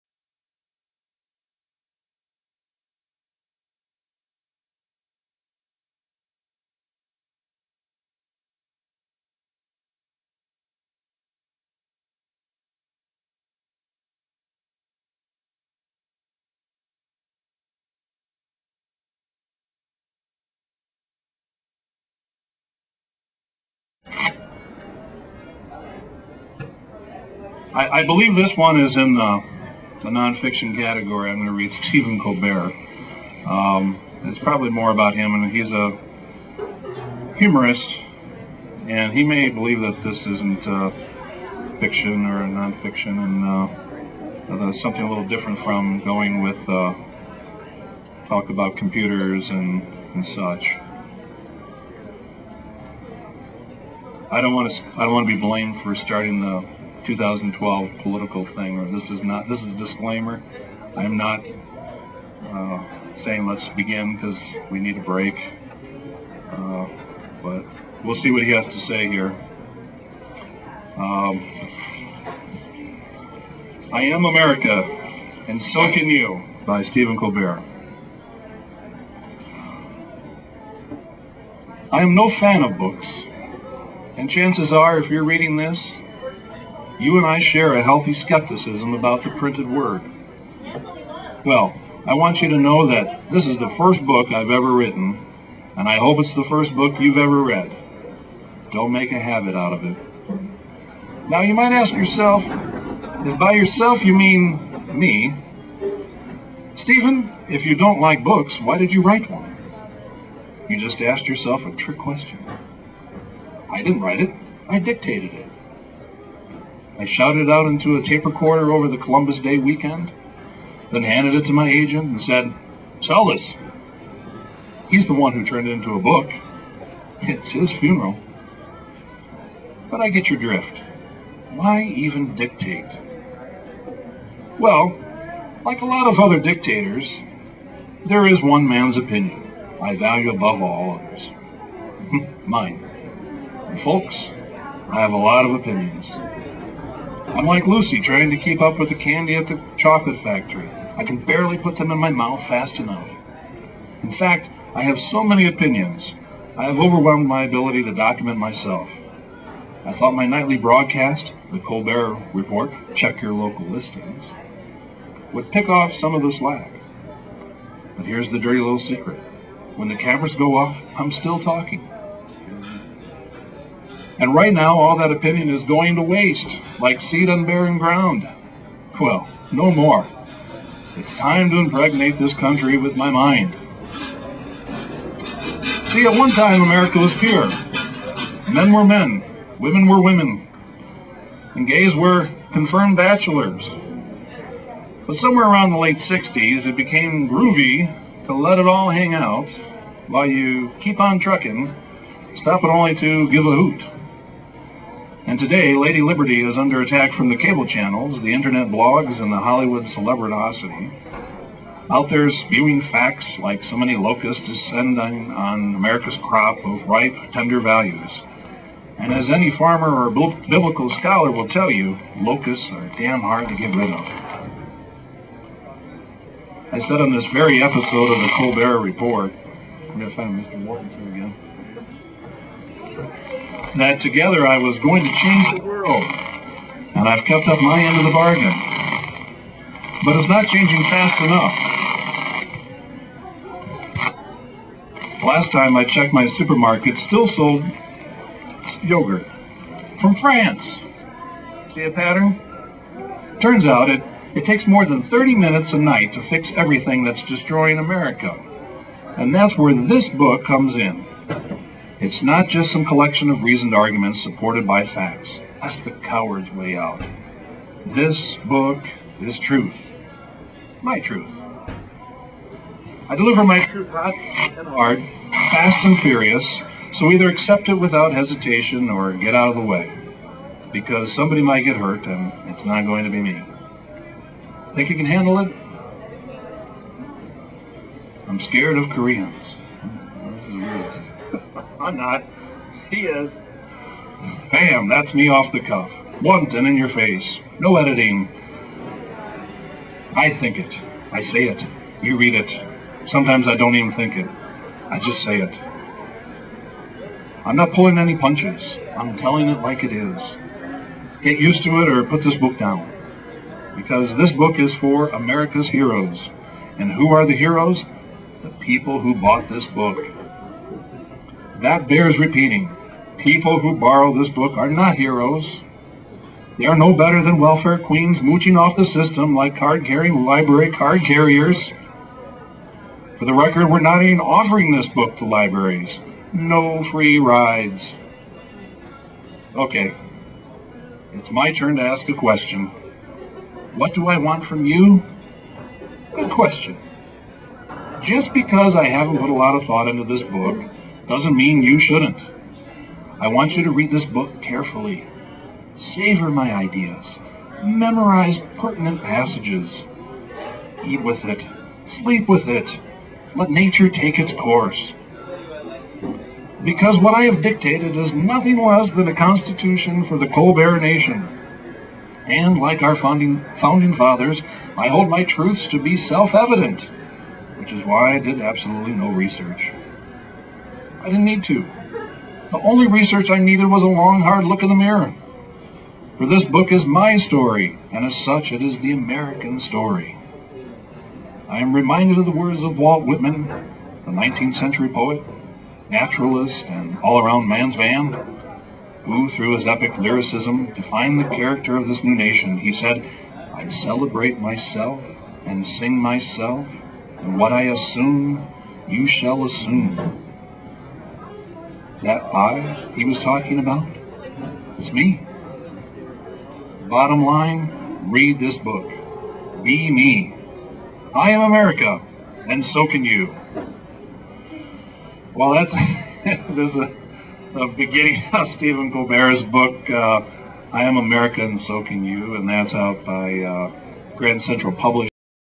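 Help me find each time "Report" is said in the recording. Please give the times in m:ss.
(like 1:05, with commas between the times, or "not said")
2:42, 3:48.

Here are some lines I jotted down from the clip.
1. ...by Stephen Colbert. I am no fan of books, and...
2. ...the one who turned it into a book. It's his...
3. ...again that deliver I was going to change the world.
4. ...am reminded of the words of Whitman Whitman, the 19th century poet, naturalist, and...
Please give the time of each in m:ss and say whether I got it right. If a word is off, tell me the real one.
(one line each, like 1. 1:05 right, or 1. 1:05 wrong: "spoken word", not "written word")
1. 1:16 right
2. 2:05 right
3. 3:52 wrong: "together", not "deliver"
4. 6:31 wrong: "Walt", not "Whitman".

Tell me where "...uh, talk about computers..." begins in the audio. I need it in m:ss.
0:46.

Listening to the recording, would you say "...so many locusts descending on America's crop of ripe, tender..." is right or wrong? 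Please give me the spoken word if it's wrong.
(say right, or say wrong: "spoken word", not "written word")
right.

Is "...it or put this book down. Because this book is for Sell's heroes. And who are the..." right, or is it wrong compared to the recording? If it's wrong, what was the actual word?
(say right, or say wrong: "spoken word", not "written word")
wrong: "America", not "Sell".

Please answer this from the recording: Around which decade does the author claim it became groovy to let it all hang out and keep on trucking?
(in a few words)
late 60s.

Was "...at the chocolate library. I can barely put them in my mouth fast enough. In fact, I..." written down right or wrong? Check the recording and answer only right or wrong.
wrong.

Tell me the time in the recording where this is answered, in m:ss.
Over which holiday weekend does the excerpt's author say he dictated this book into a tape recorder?
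1:58.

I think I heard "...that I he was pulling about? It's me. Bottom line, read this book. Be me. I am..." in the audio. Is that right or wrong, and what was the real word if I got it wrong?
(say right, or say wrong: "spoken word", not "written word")
wrong: "talking", not "pulling".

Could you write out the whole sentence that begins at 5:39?
Okay, it's my turn to ask a question.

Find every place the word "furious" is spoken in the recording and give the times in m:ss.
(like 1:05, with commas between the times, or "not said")
4:35.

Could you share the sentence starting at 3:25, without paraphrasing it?
And today, Lady Liberty is under attack from the cable channels, the internet blogs, and the Hollywood celebrinosity.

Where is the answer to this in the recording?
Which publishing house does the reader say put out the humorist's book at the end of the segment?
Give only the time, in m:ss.
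7:14.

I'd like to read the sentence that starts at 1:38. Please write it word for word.
Don't make a habit out of it.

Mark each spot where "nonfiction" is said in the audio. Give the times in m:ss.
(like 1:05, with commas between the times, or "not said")
0:30, 0:42.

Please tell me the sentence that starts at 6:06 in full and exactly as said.
Because what I have dictated is nothing less than a constitution for the Colbert Nation.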